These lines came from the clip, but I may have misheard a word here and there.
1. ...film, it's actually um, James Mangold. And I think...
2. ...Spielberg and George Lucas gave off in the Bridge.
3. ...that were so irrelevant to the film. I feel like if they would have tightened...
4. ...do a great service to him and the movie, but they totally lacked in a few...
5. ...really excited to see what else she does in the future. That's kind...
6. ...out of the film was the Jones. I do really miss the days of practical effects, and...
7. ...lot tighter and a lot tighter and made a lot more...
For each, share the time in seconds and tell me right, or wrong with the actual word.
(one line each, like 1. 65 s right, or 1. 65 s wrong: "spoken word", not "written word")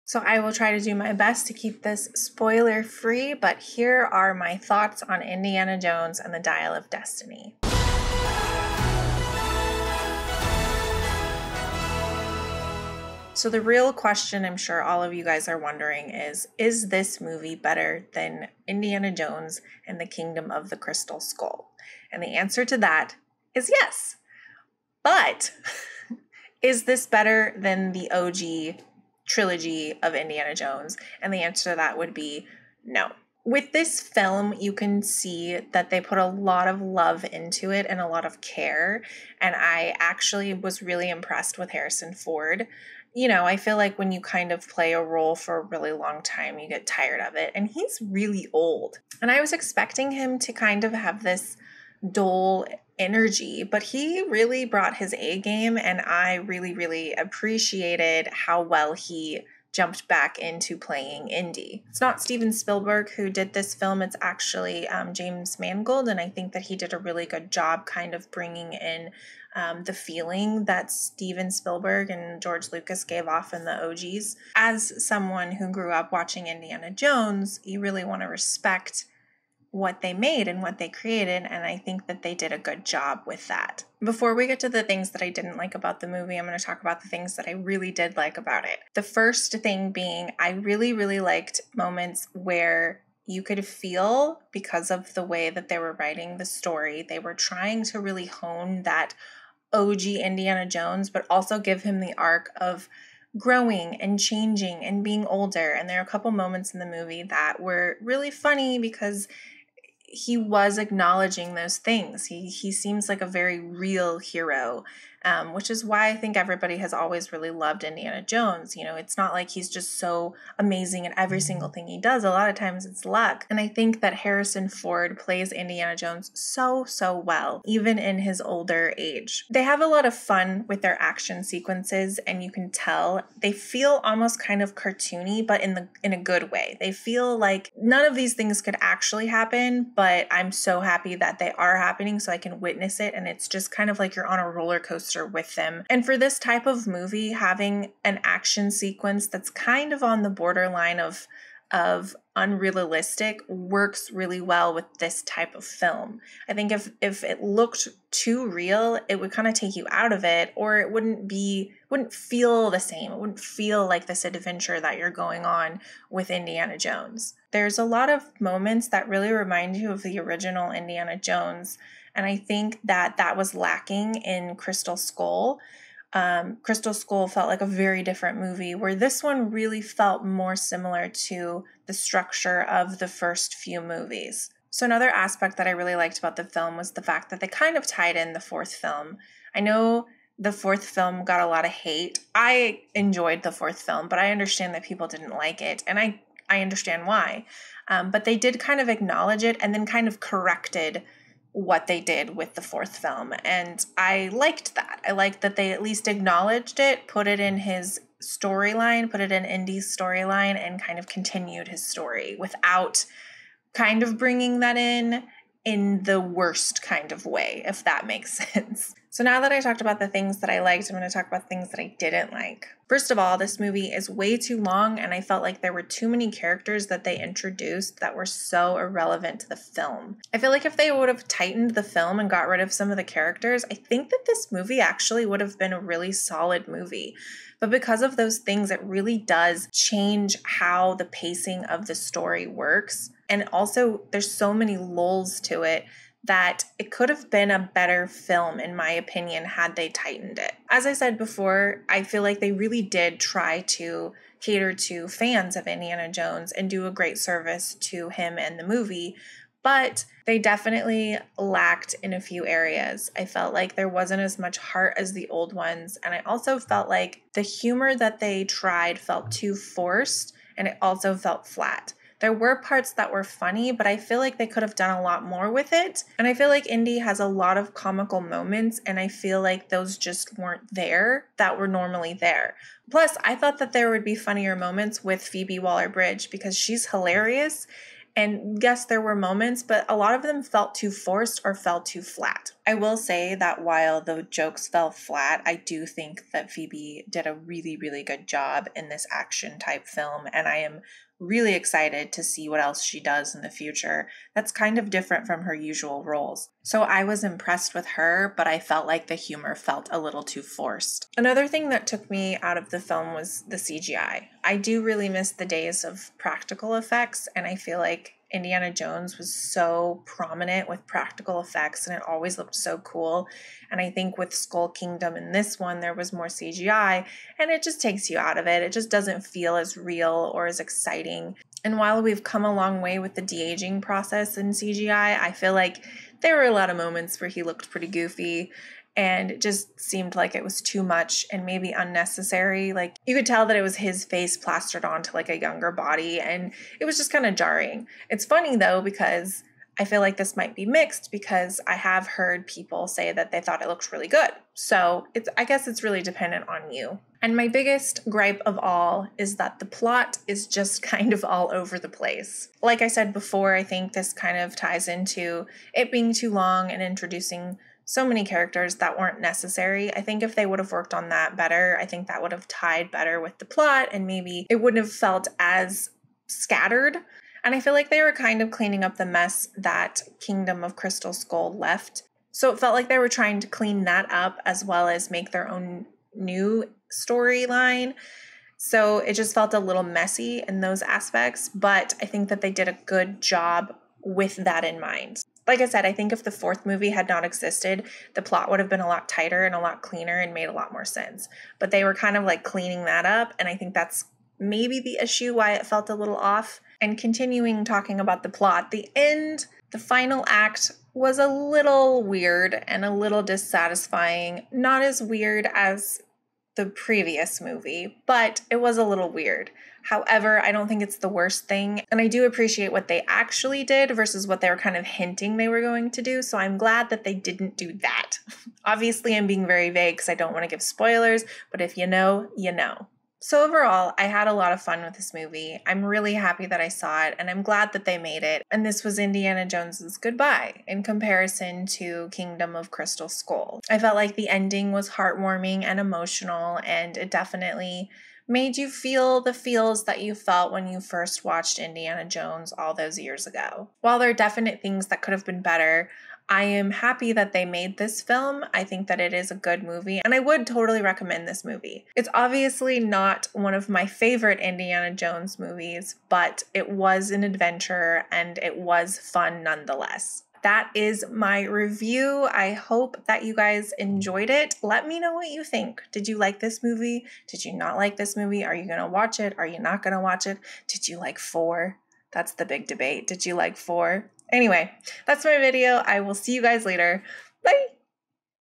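1. 63 s right
2. 71 s wrong: "OGs", not "Bridge"
3. 227 s right
4. 256 s wrong: "definitely", not "totally"
5. 301 s right
6. 312 s wrong: "CGI", not "Jones"
7. 398 s wrong: "cleaner", not "tighter".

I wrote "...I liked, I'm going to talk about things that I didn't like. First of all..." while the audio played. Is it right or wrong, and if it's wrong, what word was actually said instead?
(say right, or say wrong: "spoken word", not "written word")
right.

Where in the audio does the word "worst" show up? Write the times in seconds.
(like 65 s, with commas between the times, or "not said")
216 s, 421 s.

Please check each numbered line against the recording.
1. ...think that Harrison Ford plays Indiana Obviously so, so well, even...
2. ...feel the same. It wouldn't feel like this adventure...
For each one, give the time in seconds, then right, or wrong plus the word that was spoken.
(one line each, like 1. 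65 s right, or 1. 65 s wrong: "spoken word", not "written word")
1. 123 s wrong: "Jones", not "Obviously"
2. 162 s right.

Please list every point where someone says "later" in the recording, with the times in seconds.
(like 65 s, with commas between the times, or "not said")
486 s.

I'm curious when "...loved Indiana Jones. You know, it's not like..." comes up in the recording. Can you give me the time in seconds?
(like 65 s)
117 s.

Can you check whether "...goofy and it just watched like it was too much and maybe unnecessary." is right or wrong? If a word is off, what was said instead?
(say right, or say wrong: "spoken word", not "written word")
wrong: "seemed", not "watched".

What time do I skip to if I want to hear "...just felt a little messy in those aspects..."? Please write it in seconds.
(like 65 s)
389 s.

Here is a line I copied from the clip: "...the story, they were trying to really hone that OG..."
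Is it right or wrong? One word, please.
right.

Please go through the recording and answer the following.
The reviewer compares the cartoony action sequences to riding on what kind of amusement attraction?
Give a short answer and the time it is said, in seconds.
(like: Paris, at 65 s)
Roller coaster, at 144 s.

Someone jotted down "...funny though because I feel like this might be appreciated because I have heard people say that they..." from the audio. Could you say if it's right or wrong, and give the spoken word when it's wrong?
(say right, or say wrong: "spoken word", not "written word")
wrong: "mixed", not "appreciated".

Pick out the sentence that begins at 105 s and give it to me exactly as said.
And there are a couple moments in the movie that were really funny because he was acknowledging those things.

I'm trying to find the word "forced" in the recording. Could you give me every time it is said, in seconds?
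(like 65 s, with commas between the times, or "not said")
269 s, 290 s, 310 s.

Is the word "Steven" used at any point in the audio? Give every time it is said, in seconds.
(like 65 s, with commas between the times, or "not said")
62 s, 70 s.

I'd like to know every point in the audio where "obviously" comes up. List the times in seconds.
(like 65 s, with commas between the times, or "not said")
428 s, 462 s.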